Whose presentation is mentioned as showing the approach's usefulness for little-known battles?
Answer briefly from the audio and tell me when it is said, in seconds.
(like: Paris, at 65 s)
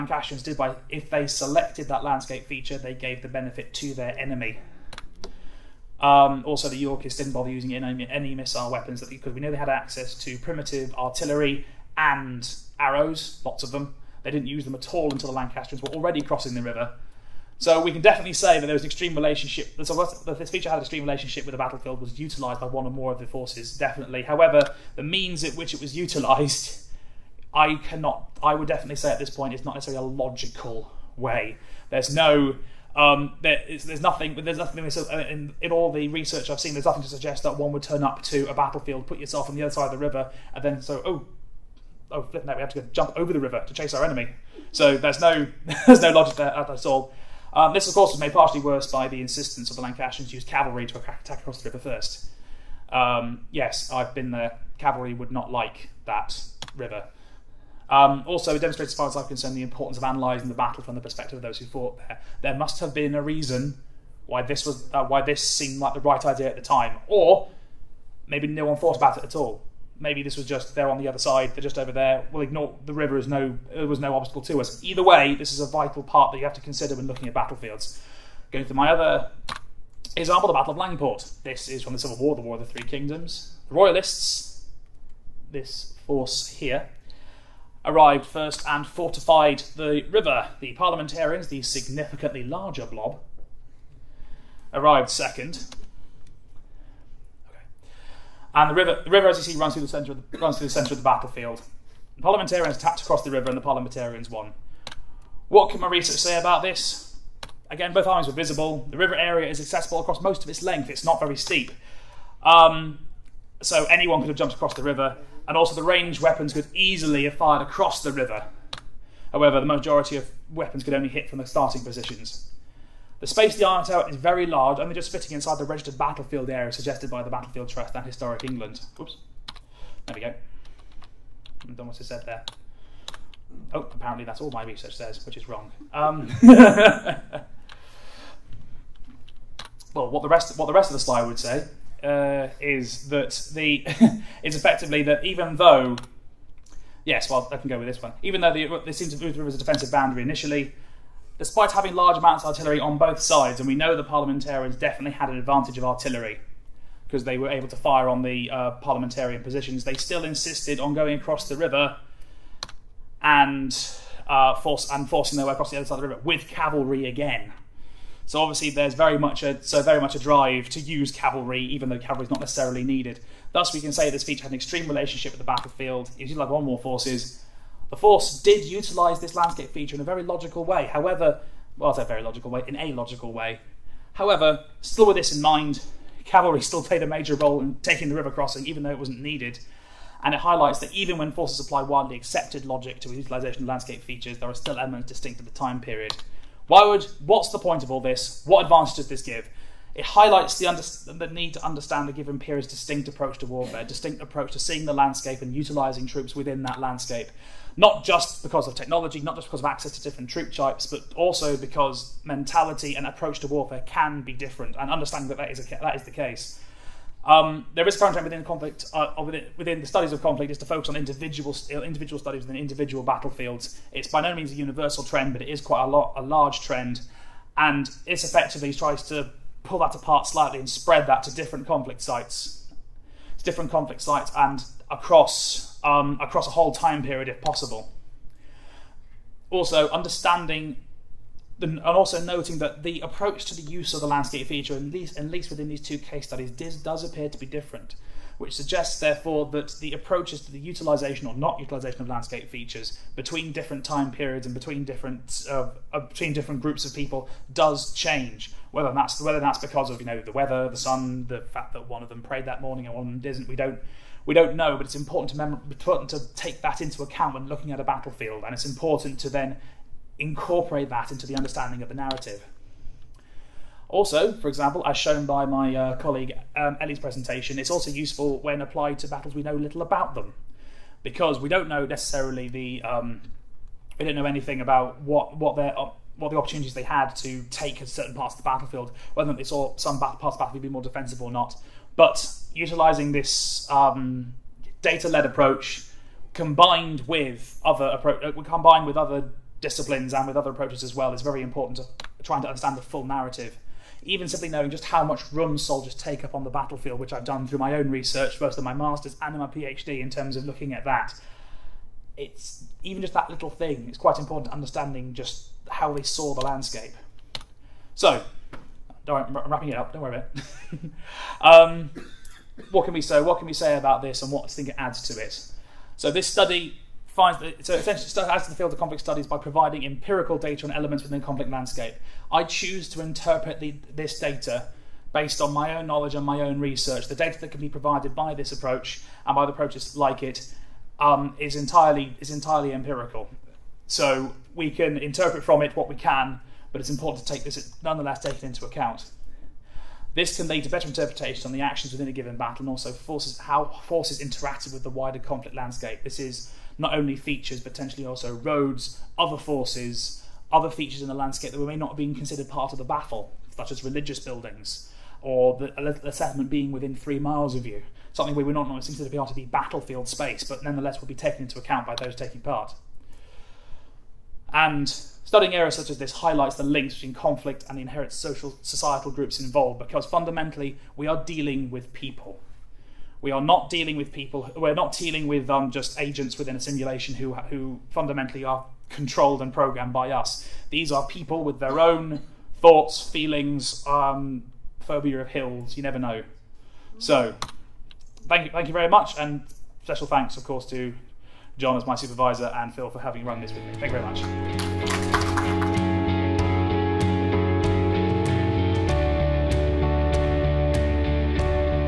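Ellie, at 276 s.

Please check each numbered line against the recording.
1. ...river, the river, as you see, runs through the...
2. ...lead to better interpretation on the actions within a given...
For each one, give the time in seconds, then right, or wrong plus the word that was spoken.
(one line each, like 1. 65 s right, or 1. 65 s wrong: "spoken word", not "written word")
1. 98 s right
2. 350 s right.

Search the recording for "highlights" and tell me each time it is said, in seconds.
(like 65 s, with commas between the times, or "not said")
190 s, 200 s, 376 s.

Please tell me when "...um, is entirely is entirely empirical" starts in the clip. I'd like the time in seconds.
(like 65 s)
340 s.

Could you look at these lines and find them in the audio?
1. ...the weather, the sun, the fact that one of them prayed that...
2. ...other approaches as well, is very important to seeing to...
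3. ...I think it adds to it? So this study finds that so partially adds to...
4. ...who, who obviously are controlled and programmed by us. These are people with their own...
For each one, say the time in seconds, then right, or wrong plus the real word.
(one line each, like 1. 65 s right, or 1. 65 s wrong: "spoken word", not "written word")
1. 260 s right
2. 300 s wrong: "trying", not "seeing"
3. 324 s wrong: "essentially", not "partially"
4. 387 s wrong: "fundamentally", not "obviously".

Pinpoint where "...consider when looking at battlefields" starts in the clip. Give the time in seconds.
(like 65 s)
76 s.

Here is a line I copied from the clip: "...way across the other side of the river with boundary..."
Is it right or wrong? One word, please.
wrong.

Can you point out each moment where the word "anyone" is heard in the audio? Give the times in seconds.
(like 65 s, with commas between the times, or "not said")
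113 s.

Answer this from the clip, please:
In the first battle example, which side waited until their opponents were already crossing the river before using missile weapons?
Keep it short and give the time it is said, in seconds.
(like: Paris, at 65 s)
Yorkists, at 6 s.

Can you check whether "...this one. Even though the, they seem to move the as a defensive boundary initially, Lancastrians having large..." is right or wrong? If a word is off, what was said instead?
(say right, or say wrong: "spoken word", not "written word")
wrong: "Despite", not "Lancastrians".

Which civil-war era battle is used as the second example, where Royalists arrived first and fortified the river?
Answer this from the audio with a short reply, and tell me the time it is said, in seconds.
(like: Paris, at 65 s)
Battle of Langport, at 80 s.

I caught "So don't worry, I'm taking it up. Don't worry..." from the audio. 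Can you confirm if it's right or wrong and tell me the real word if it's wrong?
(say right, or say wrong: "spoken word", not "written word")
wrong: "wrapping", not "taking".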